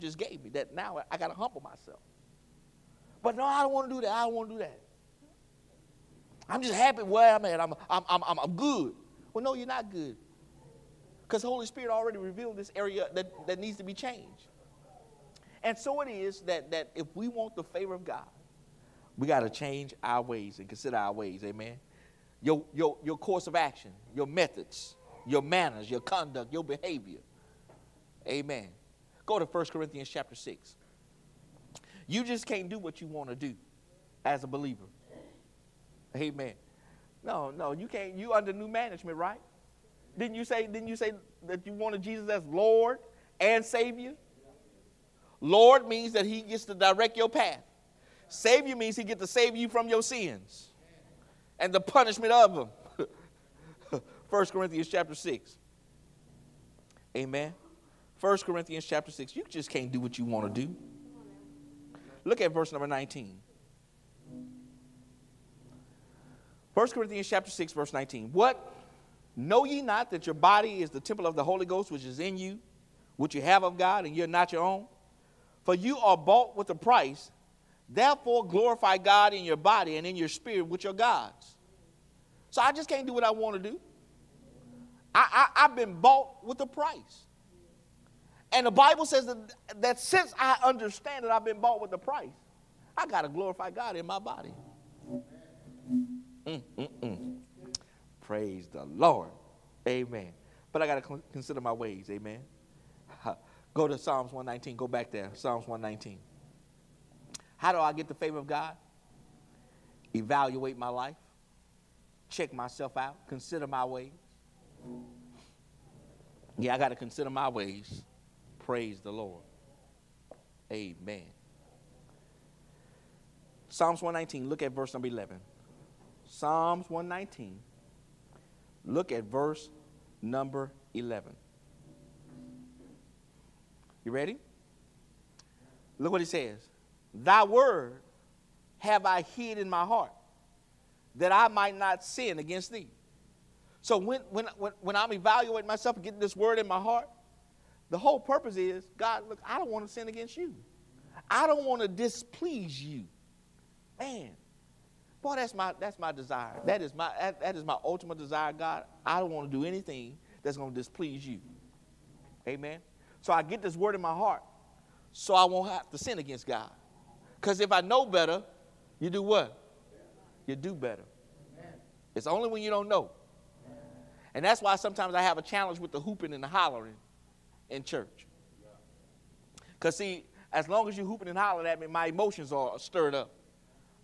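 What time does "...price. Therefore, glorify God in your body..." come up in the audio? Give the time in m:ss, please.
1:16.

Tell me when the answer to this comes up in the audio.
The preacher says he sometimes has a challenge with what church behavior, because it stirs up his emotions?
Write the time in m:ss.
2:55.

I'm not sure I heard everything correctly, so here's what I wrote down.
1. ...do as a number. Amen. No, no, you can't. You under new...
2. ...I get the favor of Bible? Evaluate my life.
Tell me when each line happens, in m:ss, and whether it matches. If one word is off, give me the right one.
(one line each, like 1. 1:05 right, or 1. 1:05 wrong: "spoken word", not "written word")
1. 0:33 wrong: "believer", not "number"
2. 1:47 wrong: "God", not "Bible".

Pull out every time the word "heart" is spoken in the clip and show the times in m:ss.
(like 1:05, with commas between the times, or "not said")
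2:19, 2:26, 2:44.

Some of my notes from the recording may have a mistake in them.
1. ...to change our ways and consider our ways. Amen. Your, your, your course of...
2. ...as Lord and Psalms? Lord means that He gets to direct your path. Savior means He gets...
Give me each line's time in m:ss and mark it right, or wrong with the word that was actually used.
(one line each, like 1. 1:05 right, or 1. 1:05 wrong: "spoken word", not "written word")
1. 0:19 right
2. 0:42 wrong: "Savior", not "Psalms".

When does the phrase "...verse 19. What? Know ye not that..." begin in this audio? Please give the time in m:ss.
1:07.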